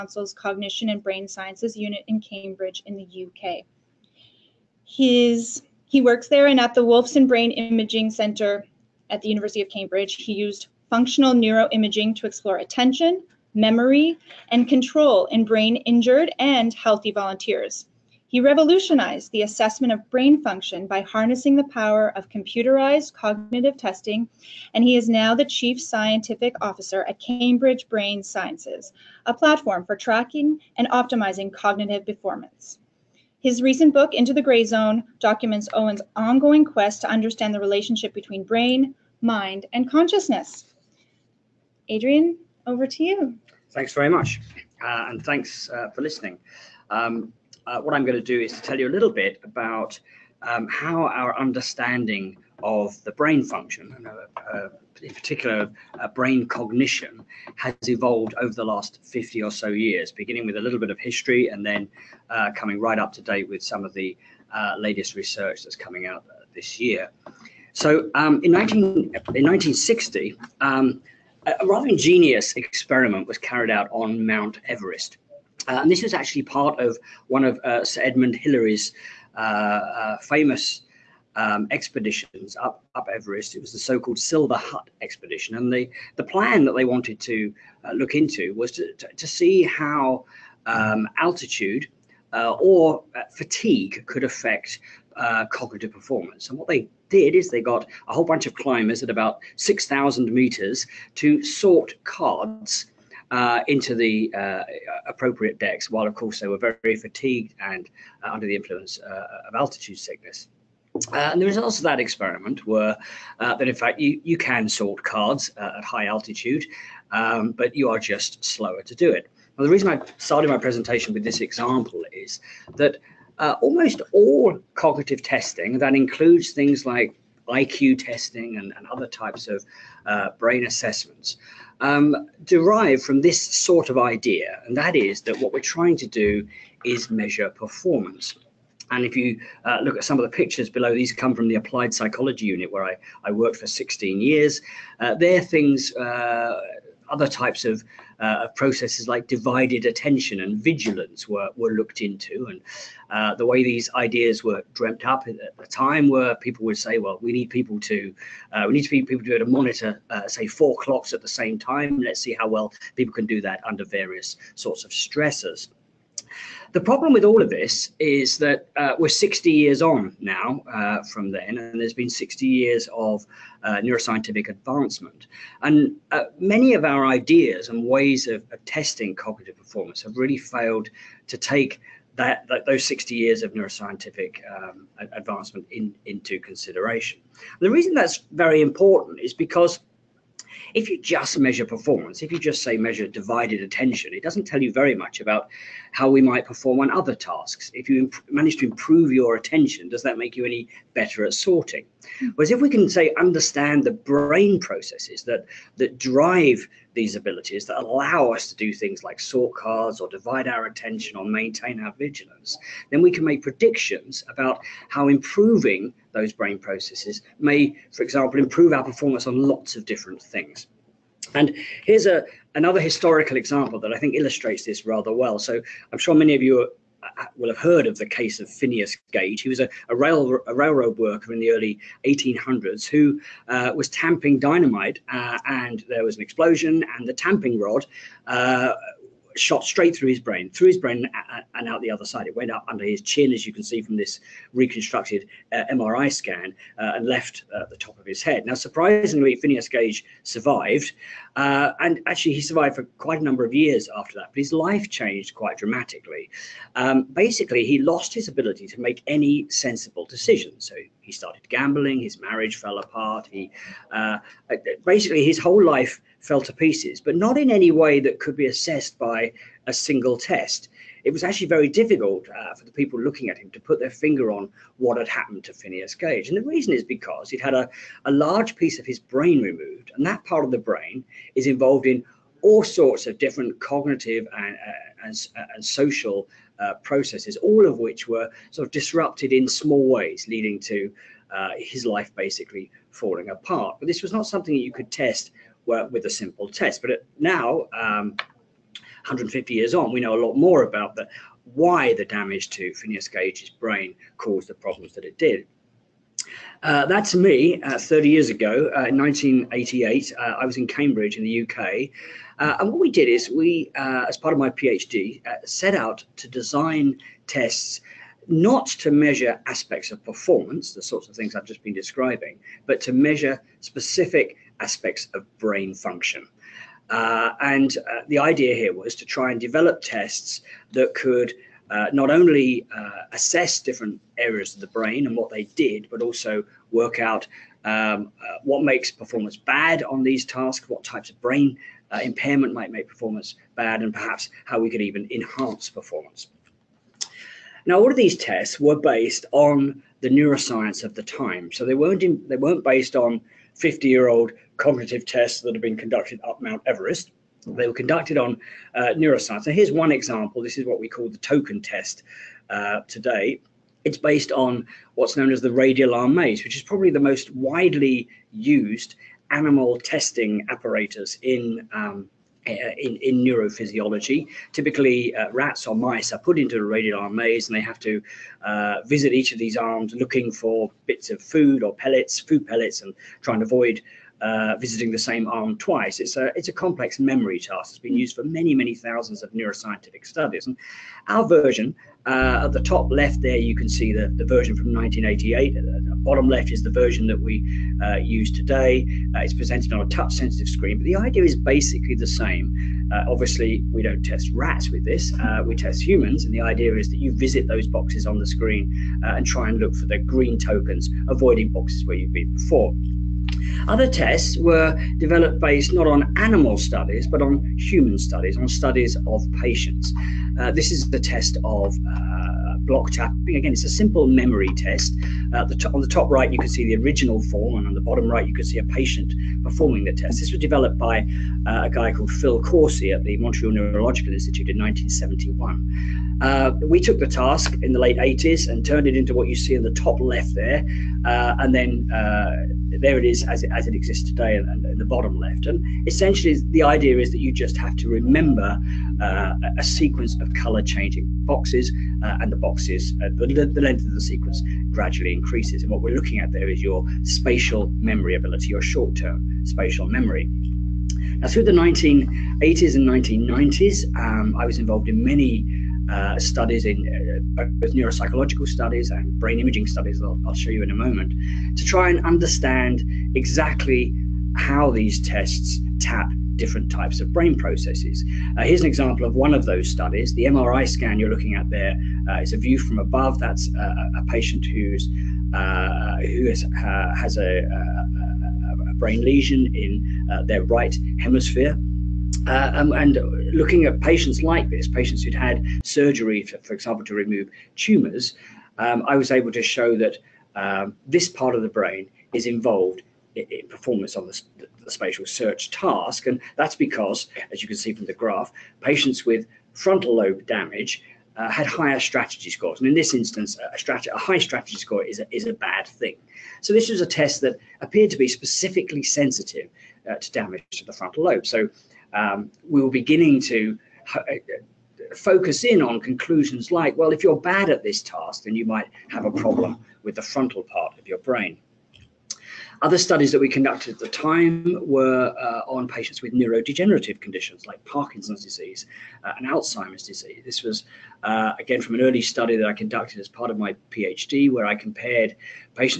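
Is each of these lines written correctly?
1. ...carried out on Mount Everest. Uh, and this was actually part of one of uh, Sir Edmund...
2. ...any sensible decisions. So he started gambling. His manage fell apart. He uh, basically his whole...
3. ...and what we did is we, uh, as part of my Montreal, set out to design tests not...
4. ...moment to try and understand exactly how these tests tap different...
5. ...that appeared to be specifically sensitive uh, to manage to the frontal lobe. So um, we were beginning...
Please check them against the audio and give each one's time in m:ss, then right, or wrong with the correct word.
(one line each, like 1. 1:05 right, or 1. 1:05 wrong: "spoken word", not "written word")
1. 1:13 right
2. 4:19 wrong: "marriage", not "manage"
3. 5:12 wrong: "PhD", not "Montreal"
4. 7:50 right
5. 8:37 wrong: "damage", not "manage".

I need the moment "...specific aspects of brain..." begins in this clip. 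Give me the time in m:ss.
5:23.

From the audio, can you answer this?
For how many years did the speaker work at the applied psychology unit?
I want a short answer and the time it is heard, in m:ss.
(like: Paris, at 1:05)
16, at 2:23.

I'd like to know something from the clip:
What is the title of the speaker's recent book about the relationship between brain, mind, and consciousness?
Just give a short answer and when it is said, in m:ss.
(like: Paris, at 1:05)
Into the Gray Zone, at 0:34.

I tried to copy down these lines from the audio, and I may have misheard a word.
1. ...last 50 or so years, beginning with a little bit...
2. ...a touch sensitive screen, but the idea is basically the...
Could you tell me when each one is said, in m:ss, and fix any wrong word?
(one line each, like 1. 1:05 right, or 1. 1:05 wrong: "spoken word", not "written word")
1. 0:58 right
2. 6:39 right.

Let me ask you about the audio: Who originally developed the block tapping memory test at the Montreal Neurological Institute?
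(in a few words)
Phil Corsi.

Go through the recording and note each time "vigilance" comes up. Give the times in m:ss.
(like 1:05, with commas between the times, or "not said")
2:30, 3:31.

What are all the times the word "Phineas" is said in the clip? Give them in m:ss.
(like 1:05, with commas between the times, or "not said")
3:48, 4:09, 4:35, 5:02.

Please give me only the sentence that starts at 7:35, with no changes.
And what we're looking at there is your spatial memory ability, your short-term spatial memory.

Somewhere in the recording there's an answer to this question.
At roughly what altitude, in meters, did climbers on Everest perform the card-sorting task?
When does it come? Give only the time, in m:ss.
1:39.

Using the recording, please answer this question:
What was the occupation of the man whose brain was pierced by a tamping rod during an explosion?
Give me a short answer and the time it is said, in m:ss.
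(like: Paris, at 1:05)
railroad worker, at 3:50.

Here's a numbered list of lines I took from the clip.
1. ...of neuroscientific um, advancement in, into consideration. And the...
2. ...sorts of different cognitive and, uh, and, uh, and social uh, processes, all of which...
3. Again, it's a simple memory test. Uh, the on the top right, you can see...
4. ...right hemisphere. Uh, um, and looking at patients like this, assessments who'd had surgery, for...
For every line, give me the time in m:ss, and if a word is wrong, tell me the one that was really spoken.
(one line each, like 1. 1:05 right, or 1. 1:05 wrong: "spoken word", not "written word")
1. 3:03 right
2. 4:42 right
3. 7:03 right
4. 8:10 wrong: "patients", not "assessments".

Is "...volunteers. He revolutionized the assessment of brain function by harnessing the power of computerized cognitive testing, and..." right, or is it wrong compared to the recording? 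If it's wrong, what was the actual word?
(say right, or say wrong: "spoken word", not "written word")
right.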